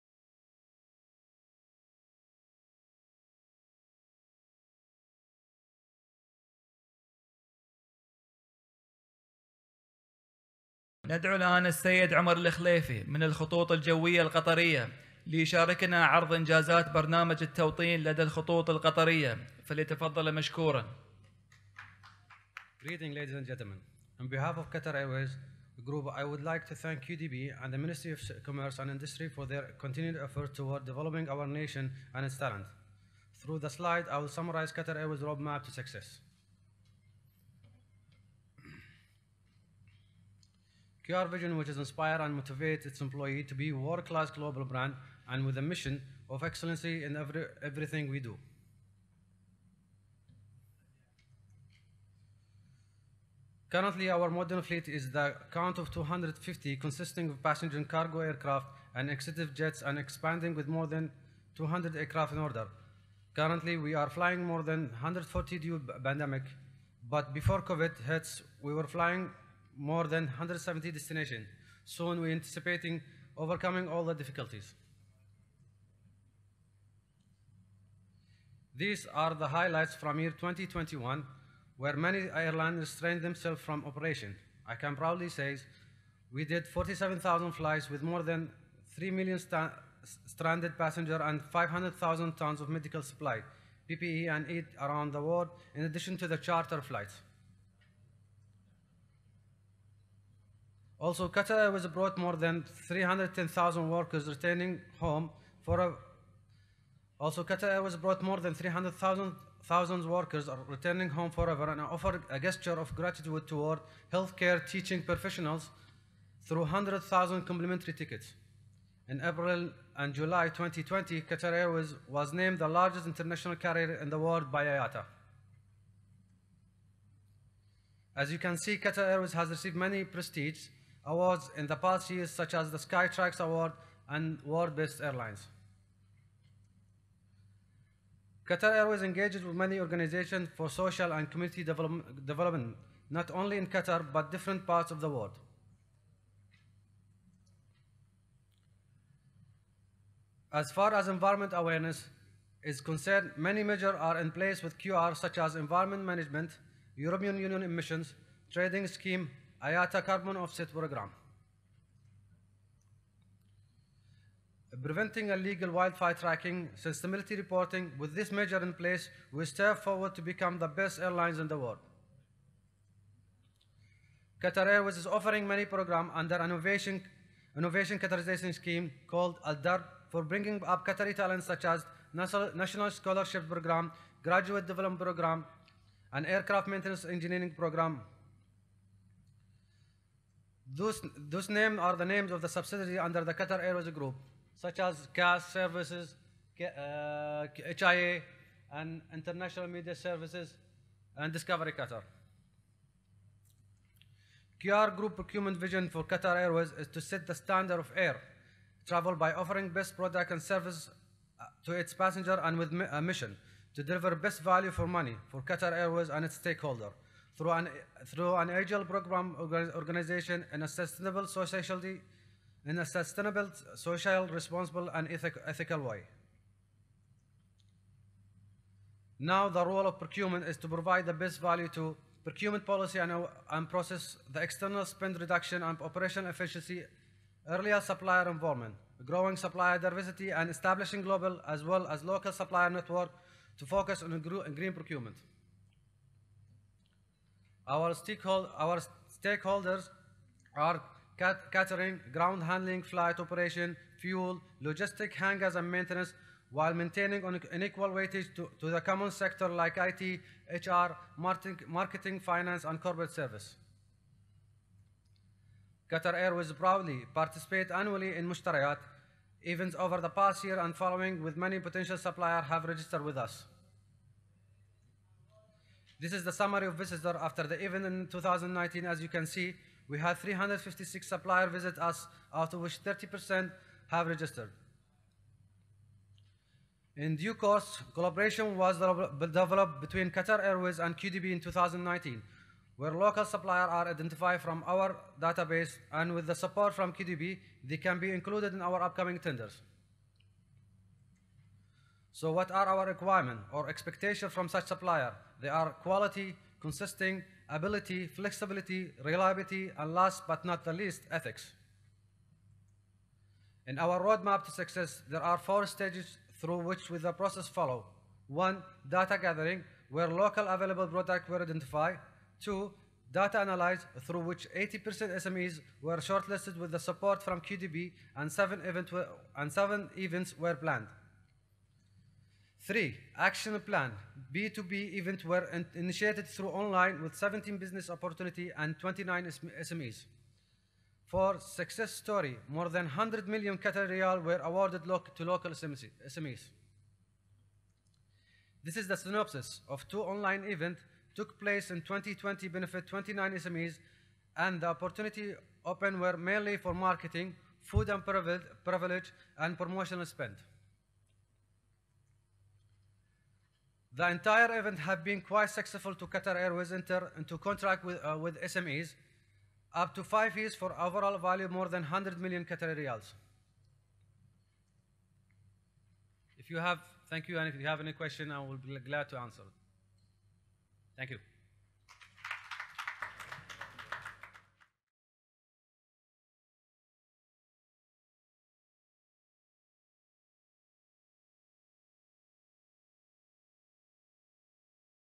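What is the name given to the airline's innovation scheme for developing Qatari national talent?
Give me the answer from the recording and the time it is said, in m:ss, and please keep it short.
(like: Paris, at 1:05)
Dar, at 2:59.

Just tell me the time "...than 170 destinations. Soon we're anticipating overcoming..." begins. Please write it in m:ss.
1:10.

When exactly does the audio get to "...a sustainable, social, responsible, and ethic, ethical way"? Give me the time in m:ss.
3:42.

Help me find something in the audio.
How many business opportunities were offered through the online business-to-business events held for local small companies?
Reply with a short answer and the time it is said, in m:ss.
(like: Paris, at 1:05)
17, at 5:37.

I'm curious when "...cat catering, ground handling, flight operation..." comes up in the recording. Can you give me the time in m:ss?
4:11.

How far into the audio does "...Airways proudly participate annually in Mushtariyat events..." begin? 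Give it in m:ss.
4:26.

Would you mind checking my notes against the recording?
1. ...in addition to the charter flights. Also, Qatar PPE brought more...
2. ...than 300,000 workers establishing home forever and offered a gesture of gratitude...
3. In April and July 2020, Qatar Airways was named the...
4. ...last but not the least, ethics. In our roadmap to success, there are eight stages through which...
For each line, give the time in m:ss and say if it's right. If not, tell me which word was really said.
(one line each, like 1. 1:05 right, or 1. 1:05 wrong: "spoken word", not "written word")
1. 1:35 wrong: "Airways", not "PPE"
2. 1:48 wrong: "returning", not "establishing"
3. 1:59 right
4. 5:09 wrong: "four", not "eight".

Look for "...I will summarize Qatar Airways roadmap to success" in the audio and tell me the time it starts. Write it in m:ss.
0:34.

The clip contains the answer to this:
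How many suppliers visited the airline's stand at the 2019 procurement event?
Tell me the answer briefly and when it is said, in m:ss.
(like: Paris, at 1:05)
356, at 4:40.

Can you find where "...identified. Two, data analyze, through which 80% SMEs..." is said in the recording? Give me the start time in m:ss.
5:21.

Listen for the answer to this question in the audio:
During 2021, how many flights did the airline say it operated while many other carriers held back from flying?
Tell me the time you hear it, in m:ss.
1:26.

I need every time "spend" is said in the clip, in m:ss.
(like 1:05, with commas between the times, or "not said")
3:54, 6:00.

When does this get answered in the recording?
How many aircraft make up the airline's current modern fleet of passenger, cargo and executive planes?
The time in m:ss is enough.
0:55.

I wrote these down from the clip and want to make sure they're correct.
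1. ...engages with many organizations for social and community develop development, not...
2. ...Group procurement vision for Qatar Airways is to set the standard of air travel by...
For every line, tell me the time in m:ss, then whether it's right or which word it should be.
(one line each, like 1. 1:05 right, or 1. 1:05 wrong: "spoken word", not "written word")
1. 2:19 right
2. 3:24 right.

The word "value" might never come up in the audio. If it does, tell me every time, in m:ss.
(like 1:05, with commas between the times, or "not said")
3:34, 3:51, 6:11.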